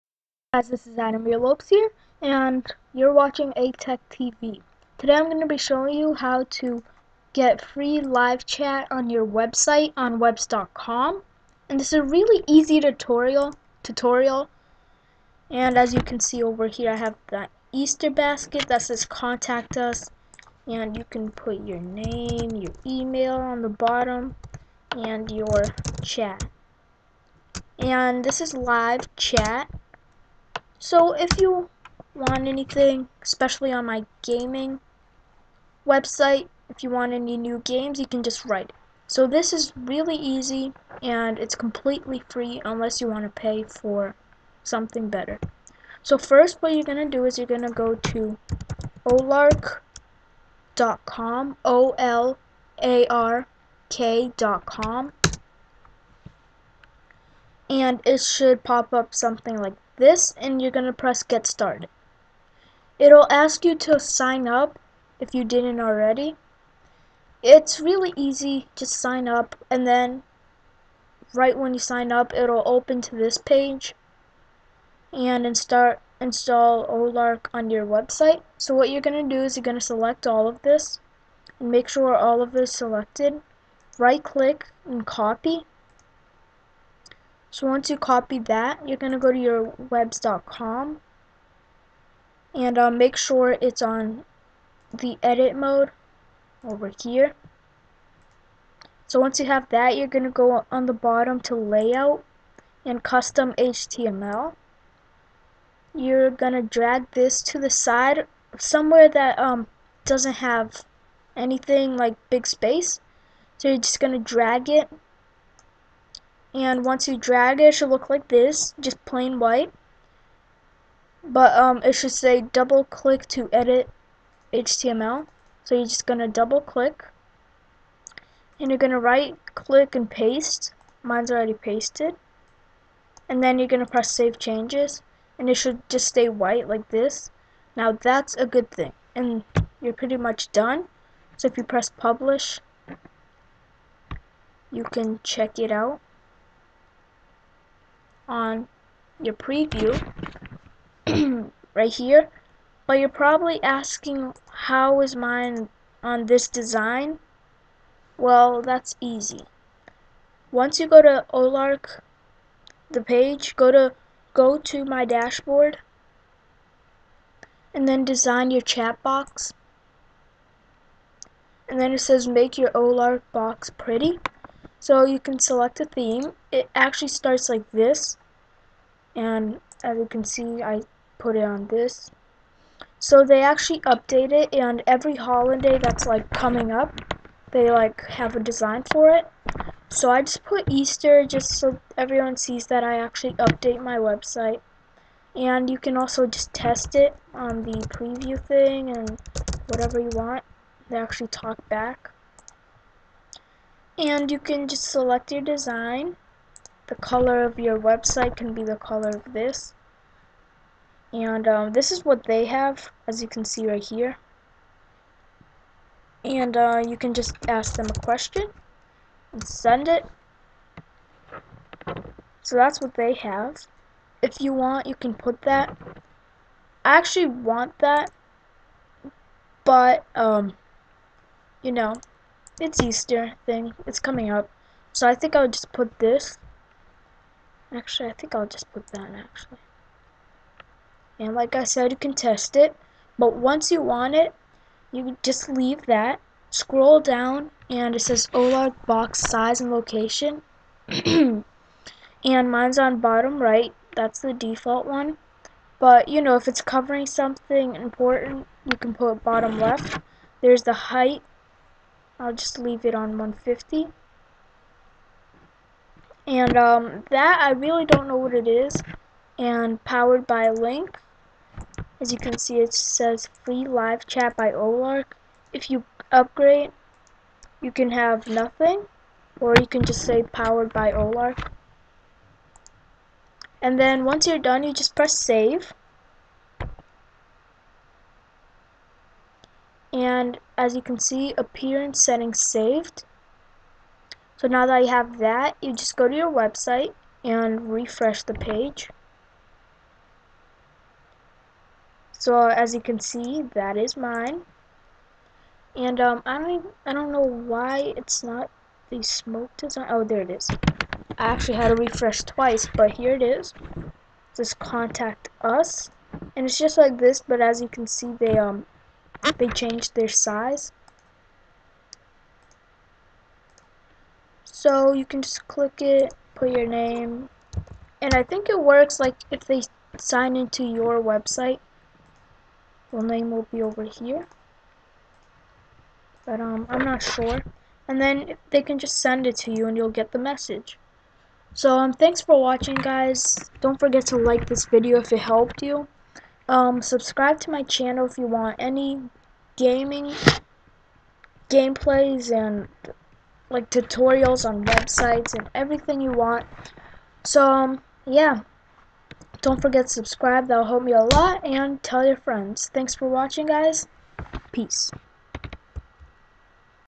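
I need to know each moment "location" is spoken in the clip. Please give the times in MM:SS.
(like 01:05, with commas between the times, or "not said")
04:09.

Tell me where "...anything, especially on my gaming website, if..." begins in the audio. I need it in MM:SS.
00:32.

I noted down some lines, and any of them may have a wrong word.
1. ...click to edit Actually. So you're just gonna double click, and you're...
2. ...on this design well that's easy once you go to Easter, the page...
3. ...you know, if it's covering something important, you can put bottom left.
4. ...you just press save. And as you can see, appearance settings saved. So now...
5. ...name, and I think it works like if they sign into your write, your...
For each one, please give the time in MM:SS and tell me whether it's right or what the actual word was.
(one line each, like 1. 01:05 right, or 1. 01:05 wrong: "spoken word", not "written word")
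1. 02:02 wrong: "HTML", not "Actually"
2. 02:36 wrong: "Olark", not "Easter"
3. 04:16 right
4. 04:44 right
5. 05:26 wrong: "website", not "write".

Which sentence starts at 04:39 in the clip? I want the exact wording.
Or you can just say powered by Olark.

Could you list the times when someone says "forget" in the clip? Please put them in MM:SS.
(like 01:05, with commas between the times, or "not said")
05:43, 05:59.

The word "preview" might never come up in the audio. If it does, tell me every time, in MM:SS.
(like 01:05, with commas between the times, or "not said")
02:29, 03:17.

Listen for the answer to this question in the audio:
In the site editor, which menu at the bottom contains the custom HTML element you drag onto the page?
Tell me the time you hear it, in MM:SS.
01:41.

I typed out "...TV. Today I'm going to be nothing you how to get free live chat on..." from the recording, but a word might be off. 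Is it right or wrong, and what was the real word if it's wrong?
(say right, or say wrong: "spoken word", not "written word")
wrong: "showing", not "nothing".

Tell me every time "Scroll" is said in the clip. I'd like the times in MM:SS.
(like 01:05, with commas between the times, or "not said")
04:06.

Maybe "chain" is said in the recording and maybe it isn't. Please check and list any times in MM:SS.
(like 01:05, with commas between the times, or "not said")
not said.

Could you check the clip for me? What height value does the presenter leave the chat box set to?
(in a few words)
150.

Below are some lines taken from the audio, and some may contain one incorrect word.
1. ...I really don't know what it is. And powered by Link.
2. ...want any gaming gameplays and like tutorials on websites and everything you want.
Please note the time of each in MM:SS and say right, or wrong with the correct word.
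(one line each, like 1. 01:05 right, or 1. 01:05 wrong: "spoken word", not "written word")
1. 04:27 right
2. 05:48 right.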